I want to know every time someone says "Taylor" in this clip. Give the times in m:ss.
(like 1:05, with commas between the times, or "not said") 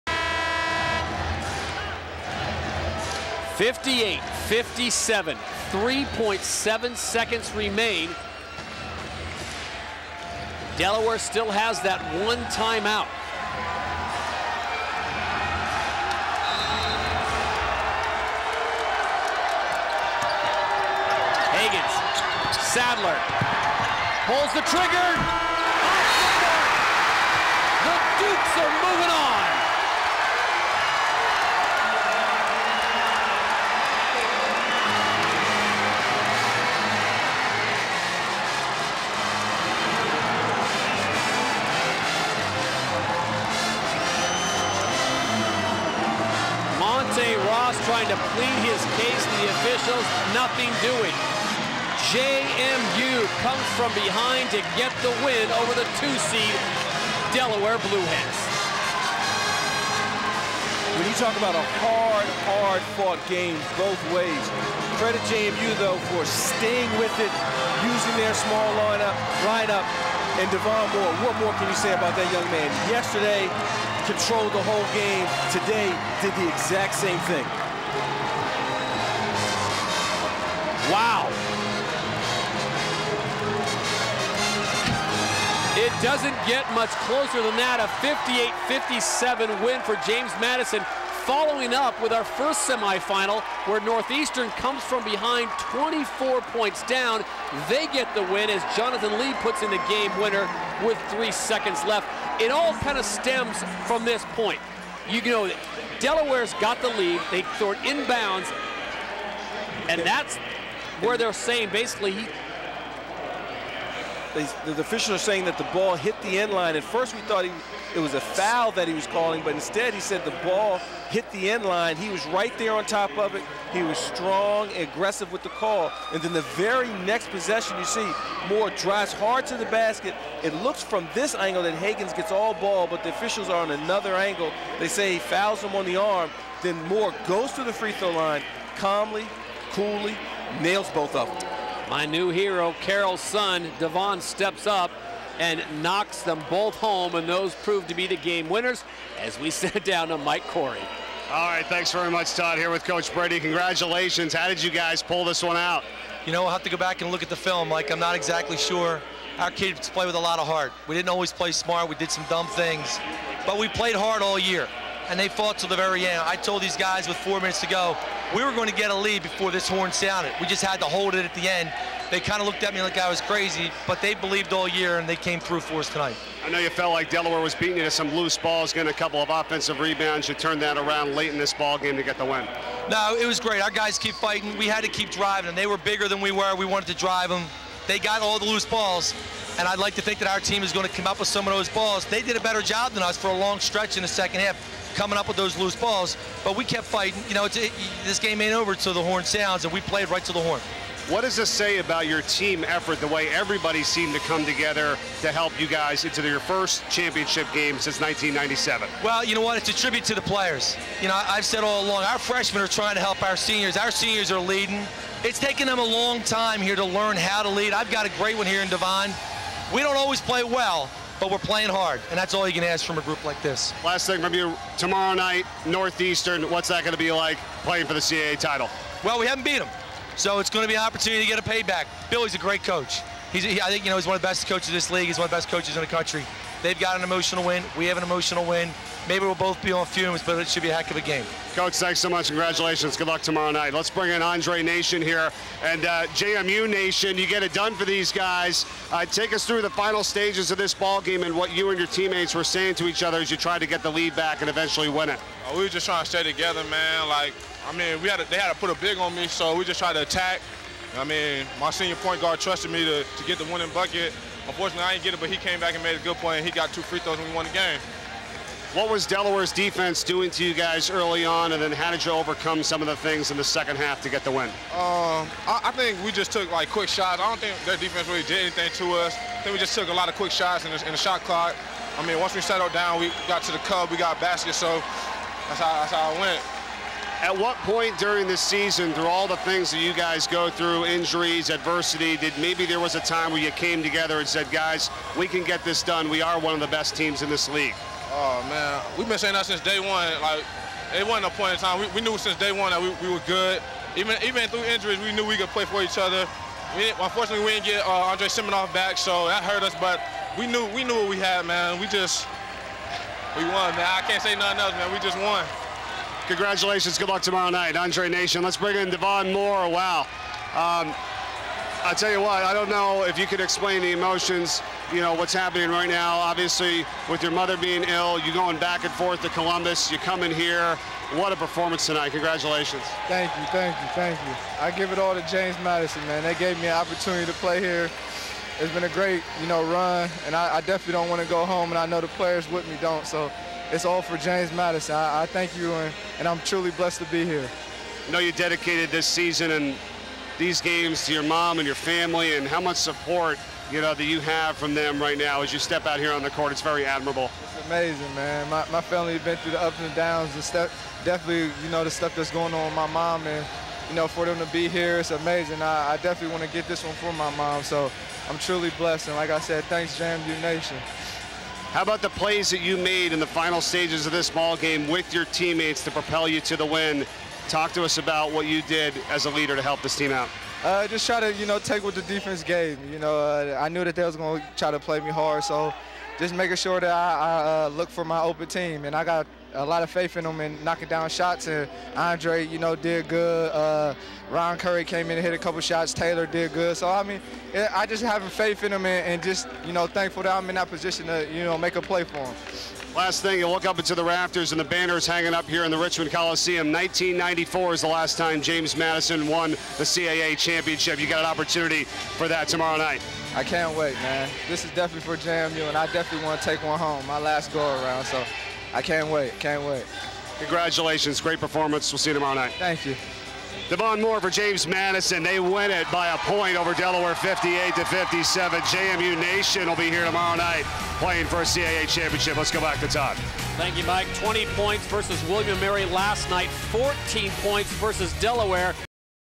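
6:35.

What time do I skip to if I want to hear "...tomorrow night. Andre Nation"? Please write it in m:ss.
5:17.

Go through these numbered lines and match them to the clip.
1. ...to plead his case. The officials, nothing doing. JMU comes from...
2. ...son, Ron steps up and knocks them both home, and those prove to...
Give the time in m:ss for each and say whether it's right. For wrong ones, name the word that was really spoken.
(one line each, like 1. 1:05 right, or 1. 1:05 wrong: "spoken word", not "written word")
1. 0:48 right
2. 2:23 wrong: "Devon", not "Ron".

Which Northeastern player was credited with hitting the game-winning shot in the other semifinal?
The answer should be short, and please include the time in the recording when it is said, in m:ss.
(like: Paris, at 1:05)
Jonathan Lee, at 1:38.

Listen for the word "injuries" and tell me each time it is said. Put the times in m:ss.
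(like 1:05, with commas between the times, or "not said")
4:50, 5:04.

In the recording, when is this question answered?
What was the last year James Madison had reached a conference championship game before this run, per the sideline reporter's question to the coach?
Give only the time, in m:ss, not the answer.
3:27.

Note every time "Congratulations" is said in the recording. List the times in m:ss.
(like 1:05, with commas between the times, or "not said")
2:33, 4:02, 5:16, 5:32, 7:00.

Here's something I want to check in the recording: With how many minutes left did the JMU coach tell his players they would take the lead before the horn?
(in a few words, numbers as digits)
4.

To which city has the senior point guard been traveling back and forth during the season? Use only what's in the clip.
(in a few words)
Columbus.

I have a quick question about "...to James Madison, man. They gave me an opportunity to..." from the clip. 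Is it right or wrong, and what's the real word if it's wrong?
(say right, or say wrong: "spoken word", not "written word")
right.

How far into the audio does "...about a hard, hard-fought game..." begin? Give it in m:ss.
1:01.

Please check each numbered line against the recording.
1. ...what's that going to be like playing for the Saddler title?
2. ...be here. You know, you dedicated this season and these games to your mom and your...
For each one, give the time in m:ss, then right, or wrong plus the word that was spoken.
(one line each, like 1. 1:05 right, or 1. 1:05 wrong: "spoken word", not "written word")
1. 3:46 wrong: "CAA", not "Saddler"
2. 5:47 right.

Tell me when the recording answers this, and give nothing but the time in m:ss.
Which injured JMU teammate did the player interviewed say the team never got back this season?
5:08.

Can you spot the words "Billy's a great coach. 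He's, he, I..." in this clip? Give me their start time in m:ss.
3:52.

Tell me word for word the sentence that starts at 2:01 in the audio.
He was right there on top of it.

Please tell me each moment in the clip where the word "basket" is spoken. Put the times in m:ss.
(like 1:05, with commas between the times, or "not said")
2:09, 4:44.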